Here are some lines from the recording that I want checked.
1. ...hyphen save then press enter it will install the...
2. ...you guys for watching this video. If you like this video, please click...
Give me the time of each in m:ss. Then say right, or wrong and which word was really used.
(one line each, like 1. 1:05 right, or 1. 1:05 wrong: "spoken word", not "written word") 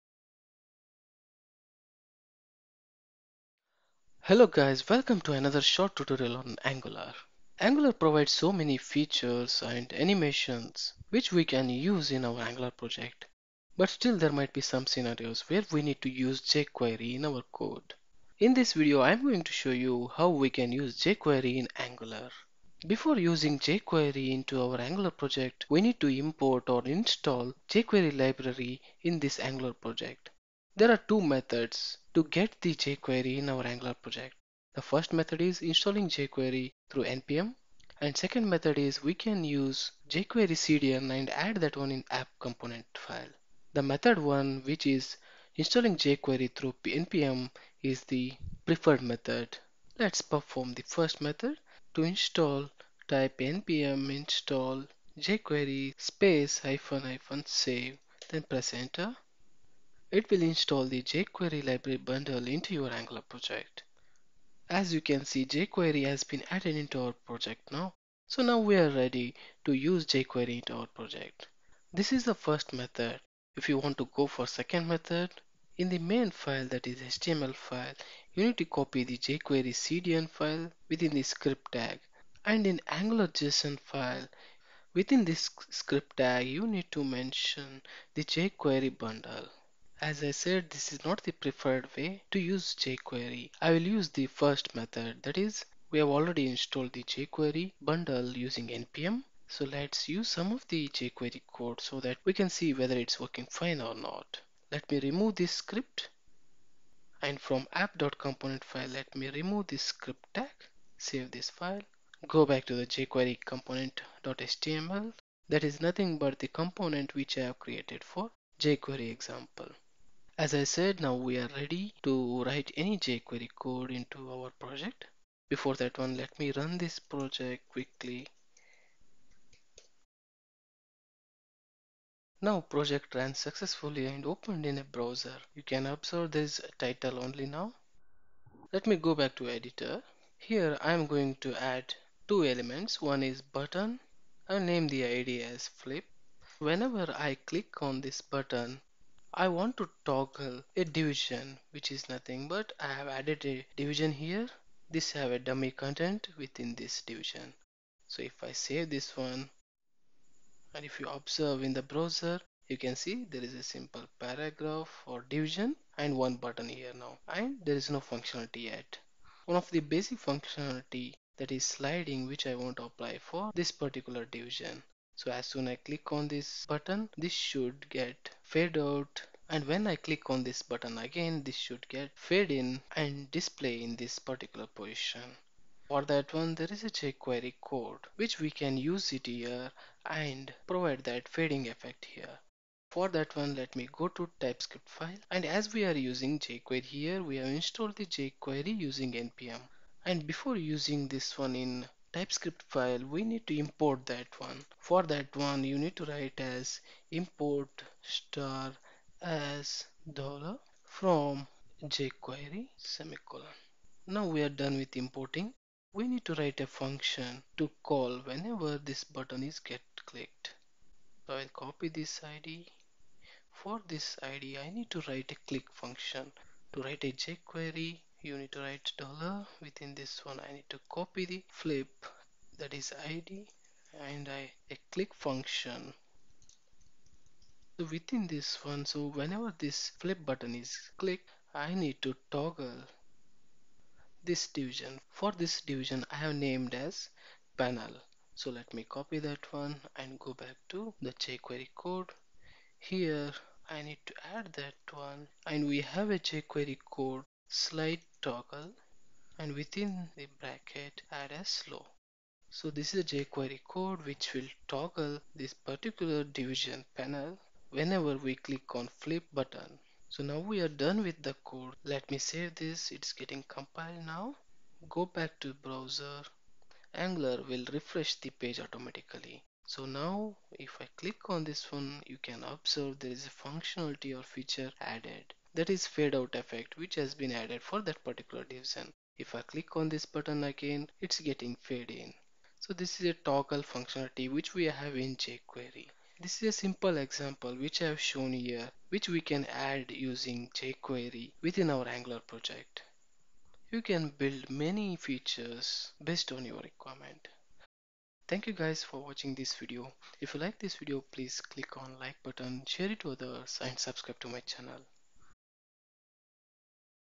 1. 0:57 right
2. 5:08 right.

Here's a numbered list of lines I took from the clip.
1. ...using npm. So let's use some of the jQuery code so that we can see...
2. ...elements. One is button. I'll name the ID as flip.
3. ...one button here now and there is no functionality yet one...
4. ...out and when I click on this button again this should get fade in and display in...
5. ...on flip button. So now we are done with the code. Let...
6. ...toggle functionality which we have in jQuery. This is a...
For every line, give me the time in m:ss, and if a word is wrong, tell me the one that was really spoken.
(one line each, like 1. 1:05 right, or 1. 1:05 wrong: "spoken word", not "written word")
1. 1:38 right
2. 2:22 right
3. 2:46 right
4. 2:58 right
5. 4:28 right
6. 4:53 right.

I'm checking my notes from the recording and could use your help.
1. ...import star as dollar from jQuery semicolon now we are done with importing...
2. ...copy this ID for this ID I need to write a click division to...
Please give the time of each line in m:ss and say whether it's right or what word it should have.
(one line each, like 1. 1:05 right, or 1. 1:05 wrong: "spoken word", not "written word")
1. 3:27 right
2. 3:41 wrong: "function", not "division".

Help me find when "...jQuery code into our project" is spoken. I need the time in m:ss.
2:02.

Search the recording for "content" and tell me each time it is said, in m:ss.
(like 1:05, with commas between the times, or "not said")
2:35.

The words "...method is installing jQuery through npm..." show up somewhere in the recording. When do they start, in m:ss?
0:35.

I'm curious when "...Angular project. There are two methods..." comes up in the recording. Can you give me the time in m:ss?
0:29.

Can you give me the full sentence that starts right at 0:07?
Angular provides so many features and animations which we can use in our Angular project.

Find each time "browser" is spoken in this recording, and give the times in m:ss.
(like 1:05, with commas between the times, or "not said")
2:14, 2:41, 4:35.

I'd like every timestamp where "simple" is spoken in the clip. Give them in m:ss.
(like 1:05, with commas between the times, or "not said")
2:43, 4:56.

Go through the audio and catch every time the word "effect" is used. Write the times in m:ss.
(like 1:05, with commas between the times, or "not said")
3:11, 4:46.